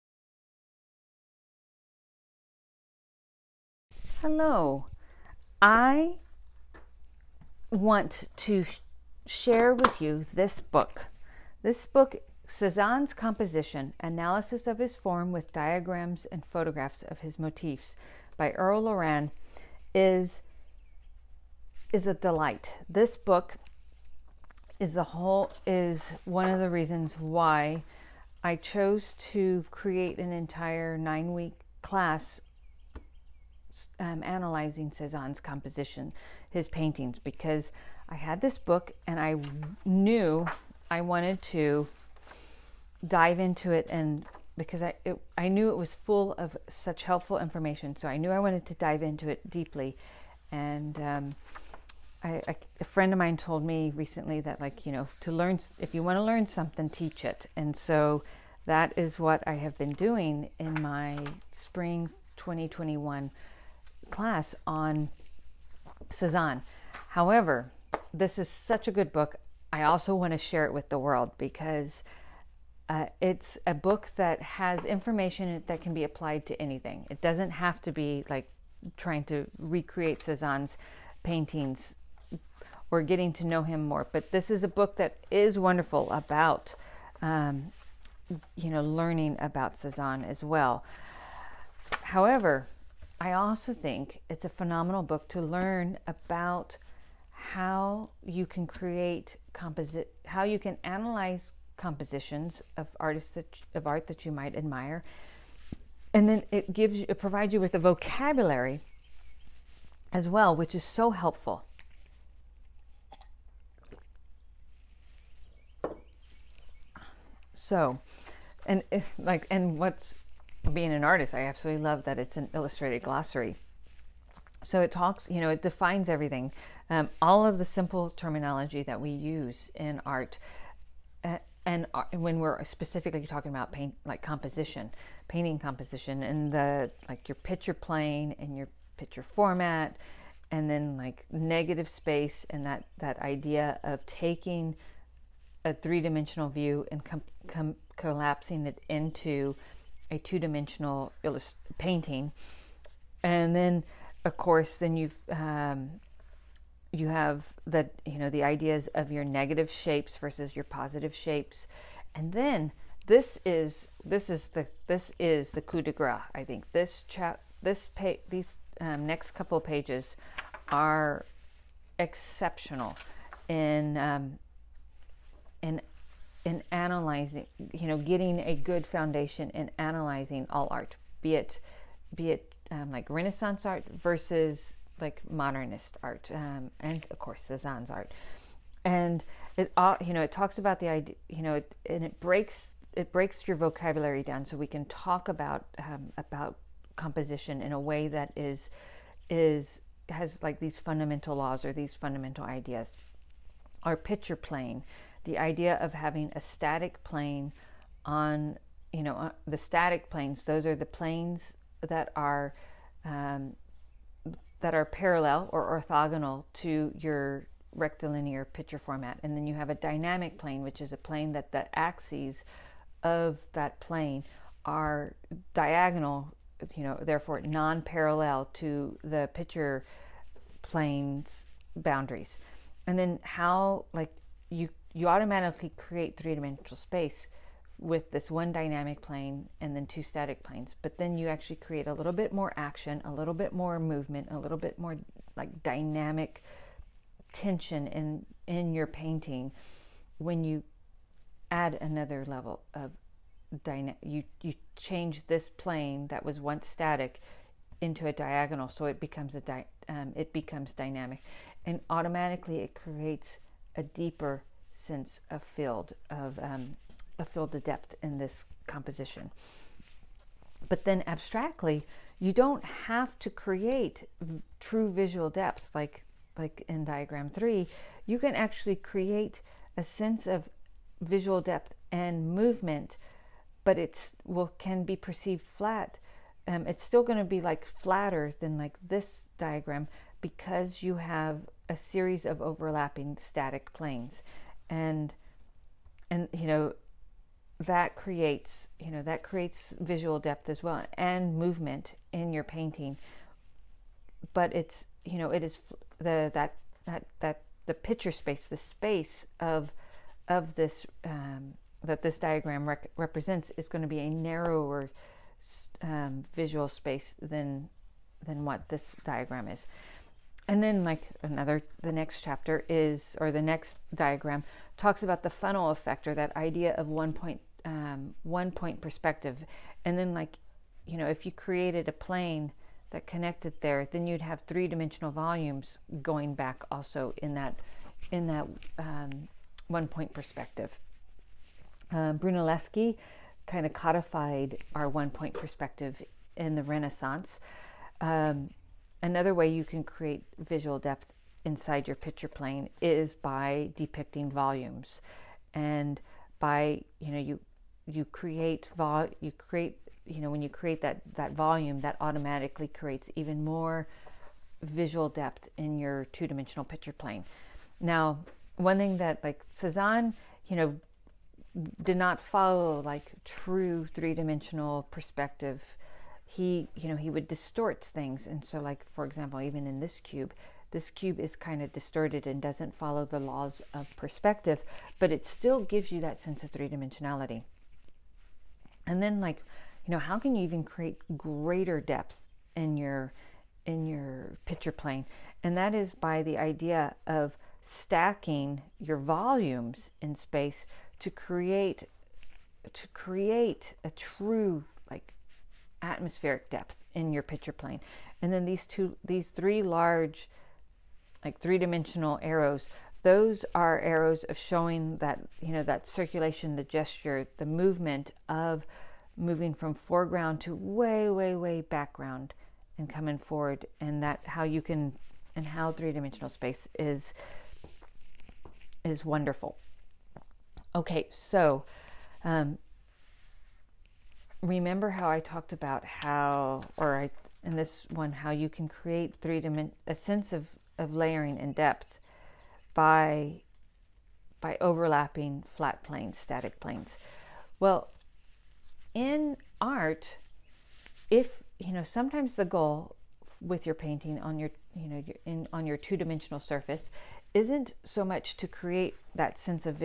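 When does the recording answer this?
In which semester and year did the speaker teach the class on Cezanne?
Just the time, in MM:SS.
01:01.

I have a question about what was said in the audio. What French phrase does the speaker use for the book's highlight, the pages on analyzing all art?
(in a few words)
coup de grace.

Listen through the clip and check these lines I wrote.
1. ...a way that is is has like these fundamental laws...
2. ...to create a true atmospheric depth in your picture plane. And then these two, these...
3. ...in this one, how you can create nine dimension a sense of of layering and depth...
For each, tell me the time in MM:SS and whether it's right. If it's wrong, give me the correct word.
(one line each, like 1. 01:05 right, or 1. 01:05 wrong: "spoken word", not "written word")
1. 03:17 right
2. 06:42 right
3. 07:17 wrong: "three", not "nine".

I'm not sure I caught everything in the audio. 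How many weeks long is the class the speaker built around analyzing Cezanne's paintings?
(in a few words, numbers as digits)
nine.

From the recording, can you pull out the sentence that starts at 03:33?
Um, that are parallel or orthogonal to your rectilinear picture format.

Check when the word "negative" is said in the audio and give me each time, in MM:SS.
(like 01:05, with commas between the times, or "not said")
02:21, 02:39.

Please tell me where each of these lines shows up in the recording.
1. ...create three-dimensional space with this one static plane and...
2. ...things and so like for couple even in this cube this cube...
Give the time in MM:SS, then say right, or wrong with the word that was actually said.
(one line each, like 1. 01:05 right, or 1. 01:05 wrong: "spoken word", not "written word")
1. 03:55 wrong: "dynamic", not "static"
2. 06:17 wrong: "example", not "couple".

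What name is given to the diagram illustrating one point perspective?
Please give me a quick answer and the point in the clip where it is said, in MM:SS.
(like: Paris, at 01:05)
funnel effect, at 05:25.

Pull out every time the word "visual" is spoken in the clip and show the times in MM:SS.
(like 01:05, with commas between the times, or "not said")
04:34, 04:41, 04:59, 05:16, 05:50, 06:04.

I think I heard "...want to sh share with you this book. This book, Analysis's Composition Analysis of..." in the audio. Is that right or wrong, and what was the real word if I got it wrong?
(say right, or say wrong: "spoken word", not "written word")
wrong: "Cezanne", not "Analysis".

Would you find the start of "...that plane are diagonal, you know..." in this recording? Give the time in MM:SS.
03:43.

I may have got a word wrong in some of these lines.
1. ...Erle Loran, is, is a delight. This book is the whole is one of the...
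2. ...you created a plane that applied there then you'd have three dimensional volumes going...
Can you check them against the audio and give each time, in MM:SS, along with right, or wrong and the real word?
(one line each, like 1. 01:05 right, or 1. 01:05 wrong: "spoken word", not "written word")
1. 00:18 right
2. 05:31 wrong: "connected", not "applied".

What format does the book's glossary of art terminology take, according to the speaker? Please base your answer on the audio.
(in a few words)
illustrated glossary.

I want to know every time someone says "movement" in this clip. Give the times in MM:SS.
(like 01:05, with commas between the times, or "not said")
04:03, 04:42, 05:01, 06:57.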